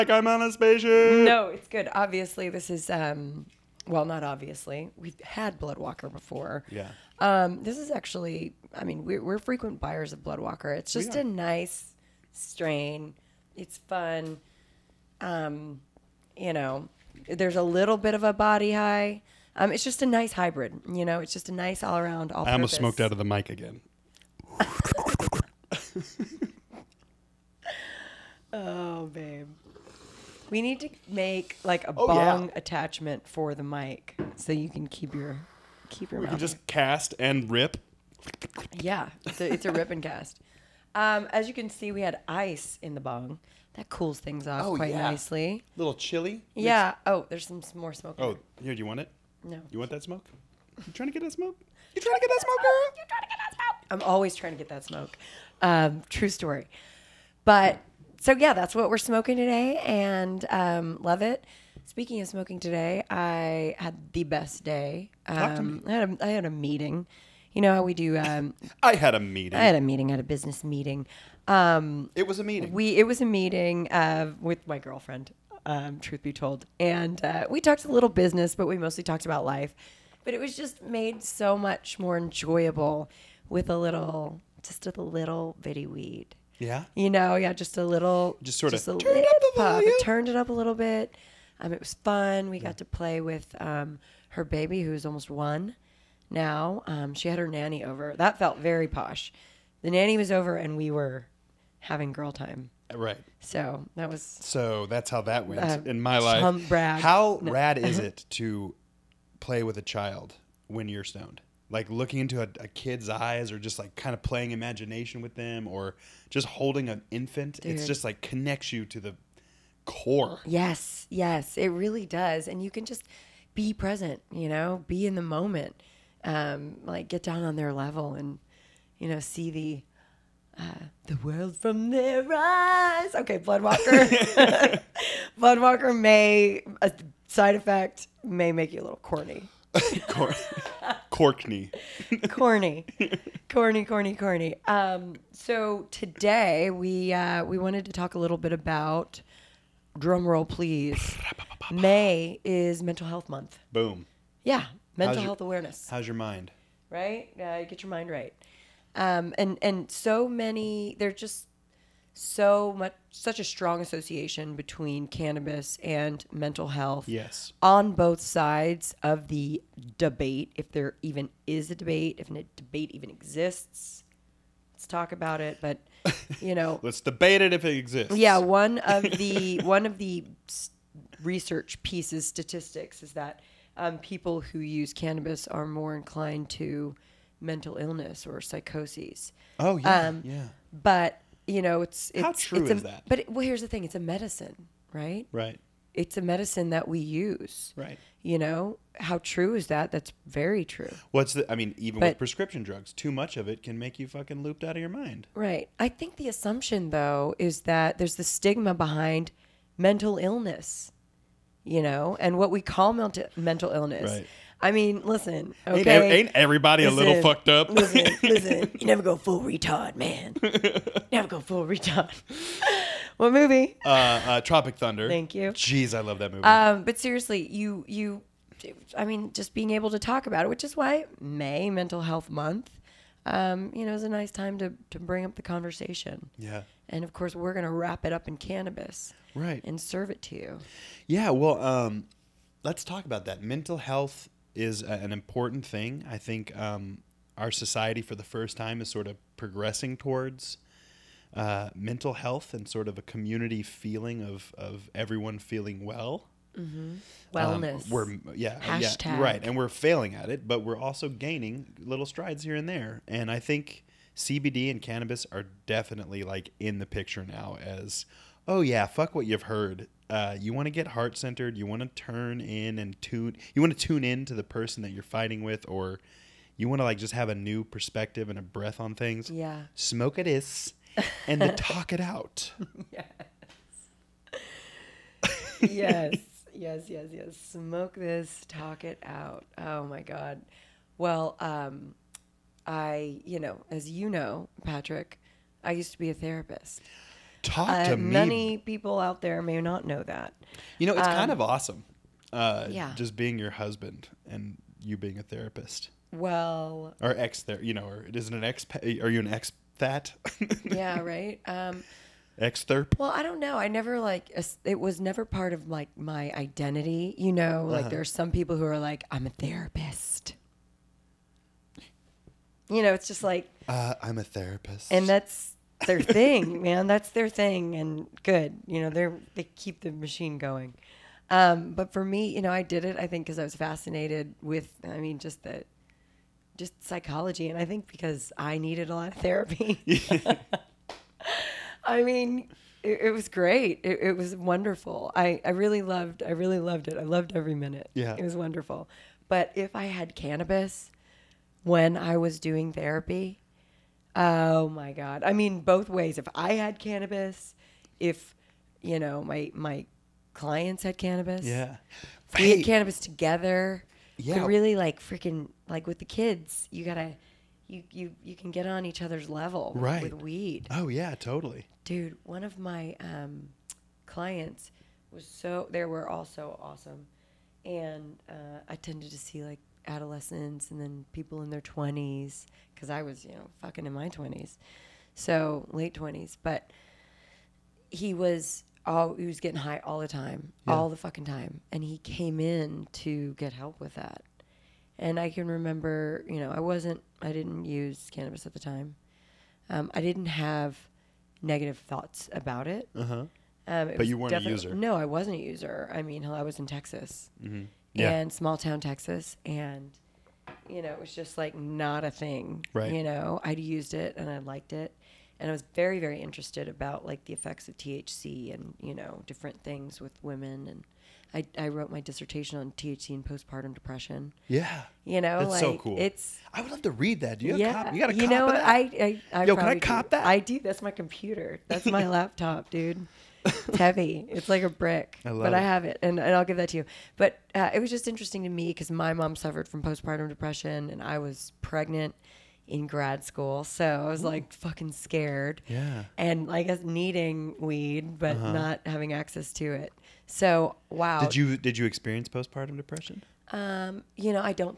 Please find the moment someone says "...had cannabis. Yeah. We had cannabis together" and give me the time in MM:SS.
06:00.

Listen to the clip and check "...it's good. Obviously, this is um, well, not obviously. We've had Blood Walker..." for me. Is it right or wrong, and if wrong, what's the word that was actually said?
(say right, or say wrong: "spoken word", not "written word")
right.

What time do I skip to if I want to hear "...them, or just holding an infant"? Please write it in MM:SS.
01:55.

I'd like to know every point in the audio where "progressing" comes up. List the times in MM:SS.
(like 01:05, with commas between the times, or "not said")
04:09.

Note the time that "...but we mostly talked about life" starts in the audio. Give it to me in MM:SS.
01:18.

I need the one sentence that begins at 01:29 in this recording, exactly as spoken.
It turned it up a little bit.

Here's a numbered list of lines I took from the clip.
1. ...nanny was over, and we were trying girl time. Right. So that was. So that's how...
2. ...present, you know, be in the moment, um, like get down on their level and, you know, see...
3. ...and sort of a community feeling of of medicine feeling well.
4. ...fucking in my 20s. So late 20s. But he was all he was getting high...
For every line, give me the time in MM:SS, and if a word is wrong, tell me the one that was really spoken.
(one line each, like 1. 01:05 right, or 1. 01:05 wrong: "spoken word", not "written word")
1. 01:39 wrong: "having", not "trying"
2. 02:03 right
3. 04:12 wrong: "everyone", not "medicine"
4. 06:23 right.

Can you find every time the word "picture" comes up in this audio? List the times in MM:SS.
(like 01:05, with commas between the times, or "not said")
04:26.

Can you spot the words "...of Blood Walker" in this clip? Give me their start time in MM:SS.
00:10.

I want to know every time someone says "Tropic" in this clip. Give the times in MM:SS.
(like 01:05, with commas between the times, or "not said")
03:44.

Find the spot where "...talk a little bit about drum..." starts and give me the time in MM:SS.
02:27.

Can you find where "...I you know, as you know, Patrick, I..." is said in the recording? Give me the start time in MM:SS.
04:52.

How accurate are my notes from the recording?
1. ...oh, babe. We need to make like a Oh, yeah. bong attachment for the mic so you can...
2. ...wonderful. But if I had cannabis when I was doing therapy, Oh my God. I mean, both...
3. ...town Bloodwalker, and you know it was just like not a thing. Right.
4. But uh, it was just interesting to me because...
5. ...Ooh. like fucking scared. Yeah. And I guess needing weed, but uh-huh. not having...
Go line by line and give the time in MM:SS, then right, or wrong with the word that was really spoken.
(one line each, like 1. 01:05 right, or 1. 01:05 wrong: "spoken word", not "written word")
1. 00:28 right
2. 05:48 right
3. 06:48 wrong: "Texas", not "Bloodwalker"
4. 07:17 right
5. 07:24 right.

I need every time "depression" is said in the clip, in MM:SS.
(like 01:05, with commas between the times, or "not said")
07:03, 07:20, 07:32.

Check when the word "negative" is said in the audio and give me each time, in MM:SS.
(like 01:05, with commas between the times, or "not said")
06:41.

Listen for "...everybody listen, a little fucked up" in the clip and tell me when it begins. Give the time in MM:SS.
03:36.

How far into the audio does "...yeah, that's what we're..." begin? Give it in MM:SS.
00:58.